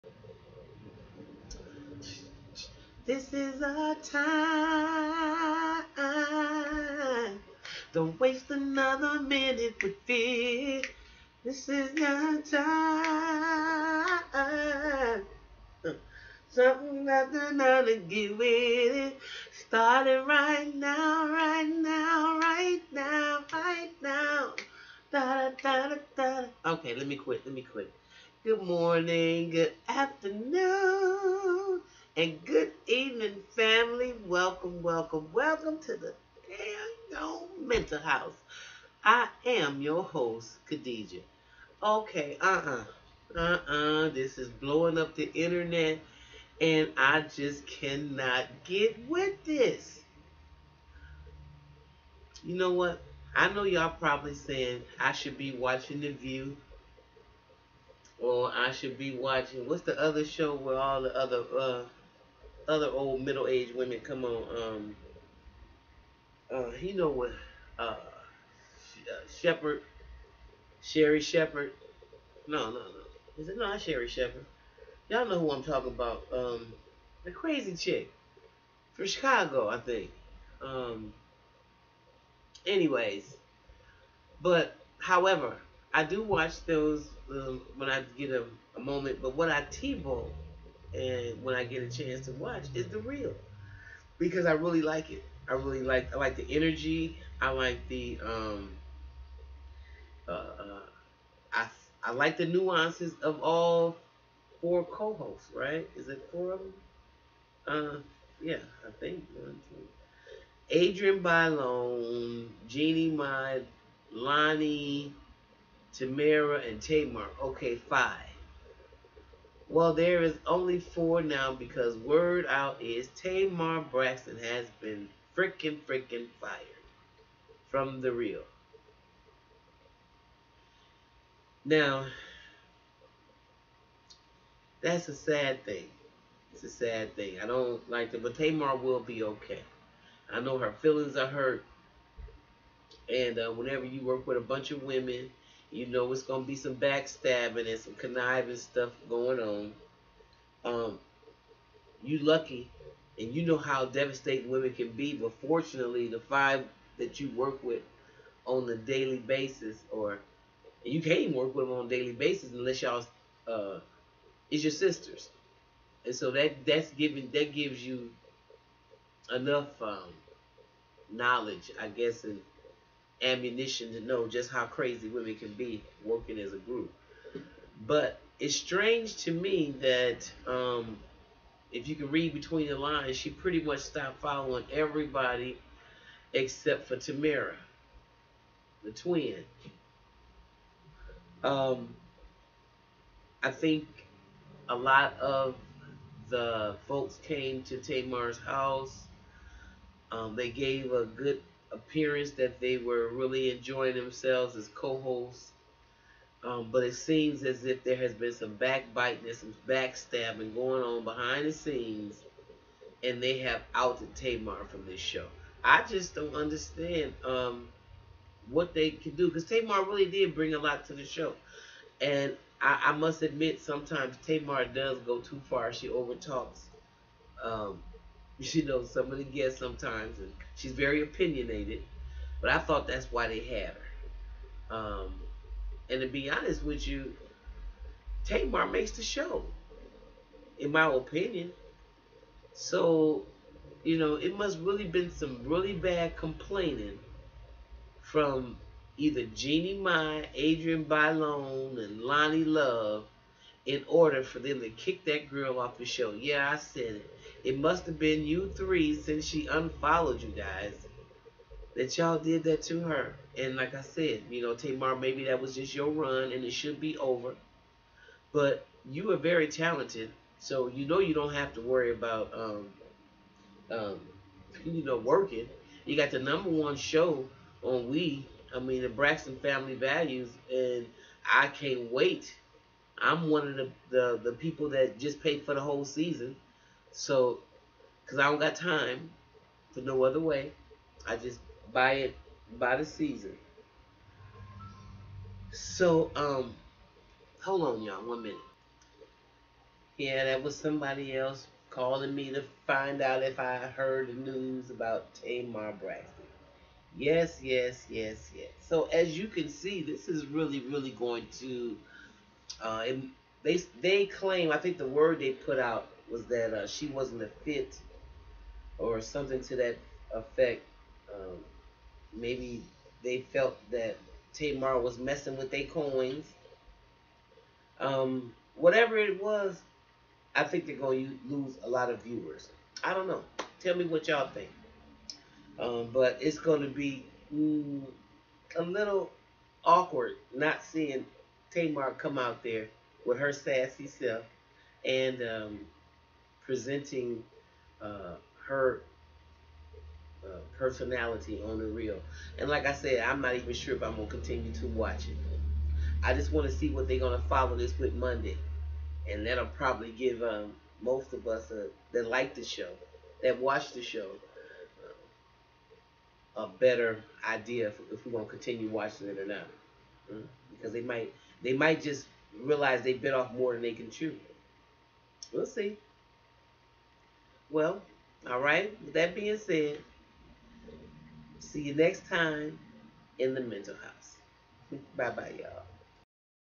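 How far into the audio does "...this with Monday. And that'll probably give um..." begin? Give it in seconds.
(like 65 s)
357 s.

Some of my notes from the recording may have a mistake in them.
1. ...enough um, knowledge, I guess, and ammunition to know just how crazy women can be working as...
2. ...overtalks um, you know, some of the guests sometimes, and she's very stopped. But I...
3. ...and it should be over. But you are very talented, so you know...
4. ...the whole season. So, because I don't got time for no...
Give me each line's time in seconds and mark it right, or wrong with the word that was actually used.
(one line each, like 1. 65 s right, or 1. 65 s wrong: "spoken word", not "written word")
1. 169 s right
2. 225 s wrong: "opinionated", not "stopped"
3. 266 s right
4. 285 s right.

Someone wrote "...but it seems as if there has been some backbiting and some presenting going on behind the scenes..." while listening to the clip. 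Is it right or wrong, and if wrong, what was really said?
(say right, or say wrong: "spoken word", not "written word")
wrong: "backstabbing", not "presenting".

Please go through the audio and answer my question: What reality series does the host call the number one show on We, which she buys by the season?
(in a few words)
Braxton Family Values.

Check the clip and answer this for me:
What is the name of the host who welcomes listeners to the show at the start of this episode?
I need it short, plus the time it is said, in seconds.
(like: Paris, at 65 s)
Khadijah, at 40 s.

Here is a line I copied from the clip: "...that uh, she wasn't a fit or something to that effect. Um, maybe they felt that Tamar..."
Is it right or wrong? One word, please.
right.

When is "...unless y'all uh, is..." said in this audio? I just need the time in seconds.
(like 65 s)
162 s.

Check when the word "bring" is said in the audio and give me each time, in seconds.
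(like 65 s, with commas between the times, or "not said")
220 s.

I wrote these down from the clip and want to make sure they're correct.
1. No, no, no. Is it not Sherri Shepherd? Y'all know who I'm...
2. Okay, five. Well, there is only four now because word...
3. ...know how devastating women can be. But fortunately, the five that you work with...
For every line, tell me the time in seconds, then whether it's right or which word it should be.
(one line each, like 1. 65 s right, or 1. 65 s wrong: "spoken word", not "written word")
1. 72 s right
2. 117 s right
3. 153 s right.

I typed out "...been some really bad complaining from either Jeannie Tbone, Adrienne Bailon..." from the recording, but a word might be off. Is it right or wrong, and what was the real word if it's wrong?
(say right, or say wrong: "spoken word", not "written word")
wrong: "Mai", not "Tbone".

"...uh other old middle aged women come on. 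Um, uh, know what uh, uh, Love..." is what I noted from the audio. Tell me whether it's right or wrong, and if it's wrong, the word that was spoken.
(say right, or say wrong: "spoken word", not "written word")
wrong: "Shepherd", not "Love".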